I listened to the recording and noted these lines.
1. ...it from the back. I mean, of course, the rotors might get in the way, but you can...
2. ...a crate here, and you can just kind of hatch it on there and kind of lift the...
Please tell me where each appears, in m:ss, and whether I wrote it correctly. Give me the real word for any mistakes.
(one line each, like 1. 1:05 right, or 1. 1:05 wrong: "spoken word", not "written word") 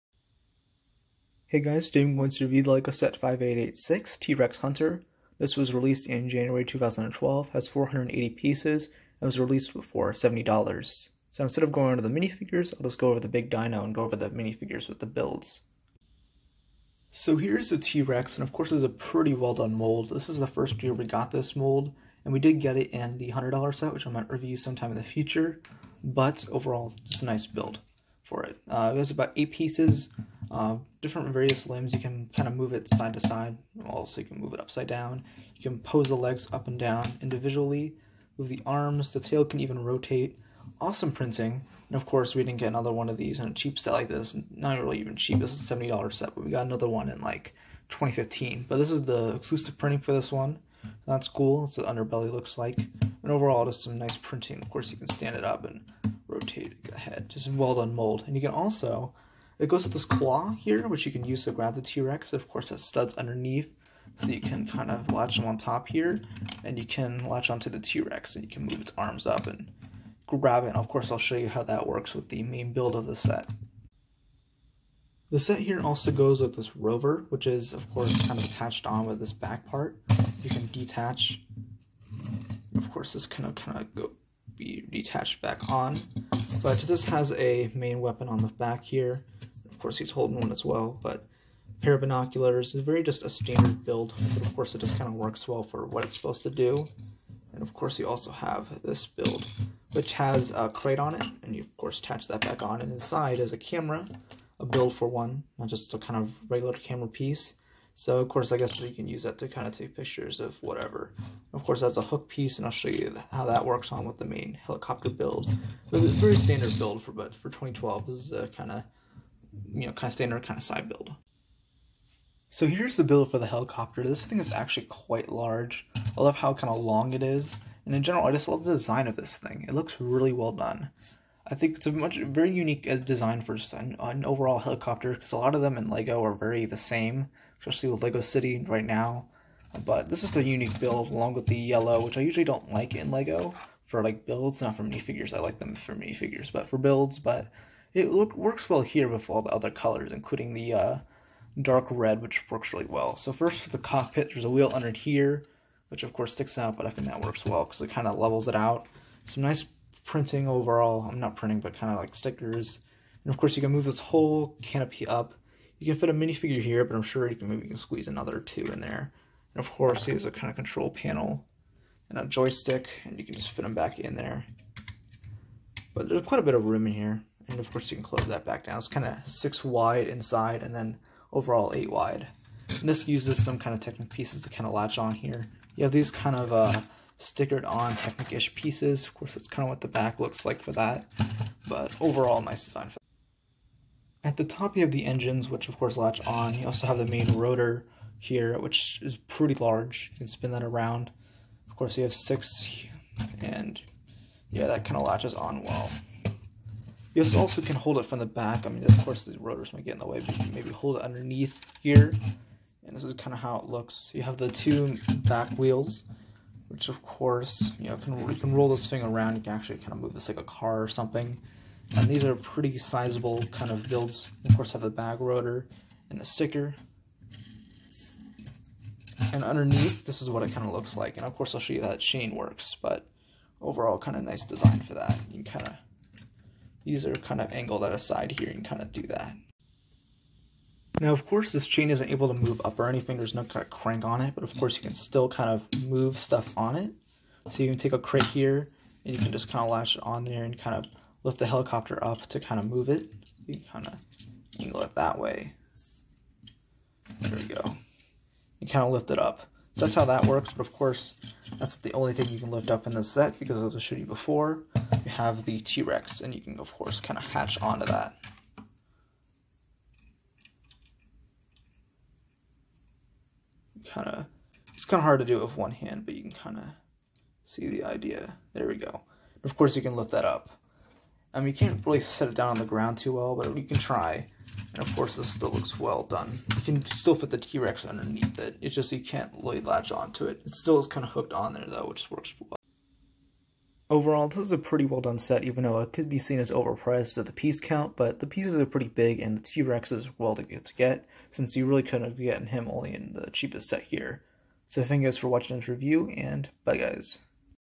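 1. 3:27 right
2. 4:07 wrong: "latch", not "hatch".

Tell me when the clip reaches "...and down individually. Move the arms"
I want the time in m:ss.
0:36.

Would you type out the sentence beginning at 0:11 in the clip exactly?
So instead of going over the minifigures, I'll just go over the big dino and go over the minifigures with the builds.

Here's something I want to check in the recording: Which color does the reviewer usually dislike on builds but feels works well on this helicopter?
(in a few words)
yellow.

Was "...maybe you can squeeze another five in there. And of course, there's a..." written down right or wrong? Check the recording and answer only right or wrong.
wrong.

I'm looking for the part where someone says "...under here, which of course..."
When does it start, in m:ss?
2:34.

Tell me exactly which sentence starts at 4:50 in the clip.
It still is kind of hooked on there, though, which works well.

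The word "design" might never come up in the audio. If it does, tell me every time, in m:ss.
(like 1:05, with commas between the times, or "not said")
2:08, 2:12, 3:12, 3:54.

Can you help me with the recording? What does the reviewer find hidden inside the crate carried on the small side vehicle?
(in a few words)
a camera.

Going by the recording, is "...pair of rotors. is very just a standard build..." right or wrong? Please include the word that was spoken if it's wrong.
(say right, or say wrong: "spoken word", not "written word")
wrong: "binoculars", not "rotors".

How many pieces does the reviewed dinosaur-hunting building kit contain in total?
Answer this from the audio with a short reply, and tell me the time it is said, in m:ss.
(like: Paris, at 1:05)
480, at 0:07.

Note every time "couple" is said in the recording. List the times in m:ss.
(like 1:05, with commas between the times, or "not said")
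not said.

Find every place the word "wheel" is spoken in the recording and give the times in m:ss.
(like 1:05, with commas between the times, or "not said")
2:34, 3:35.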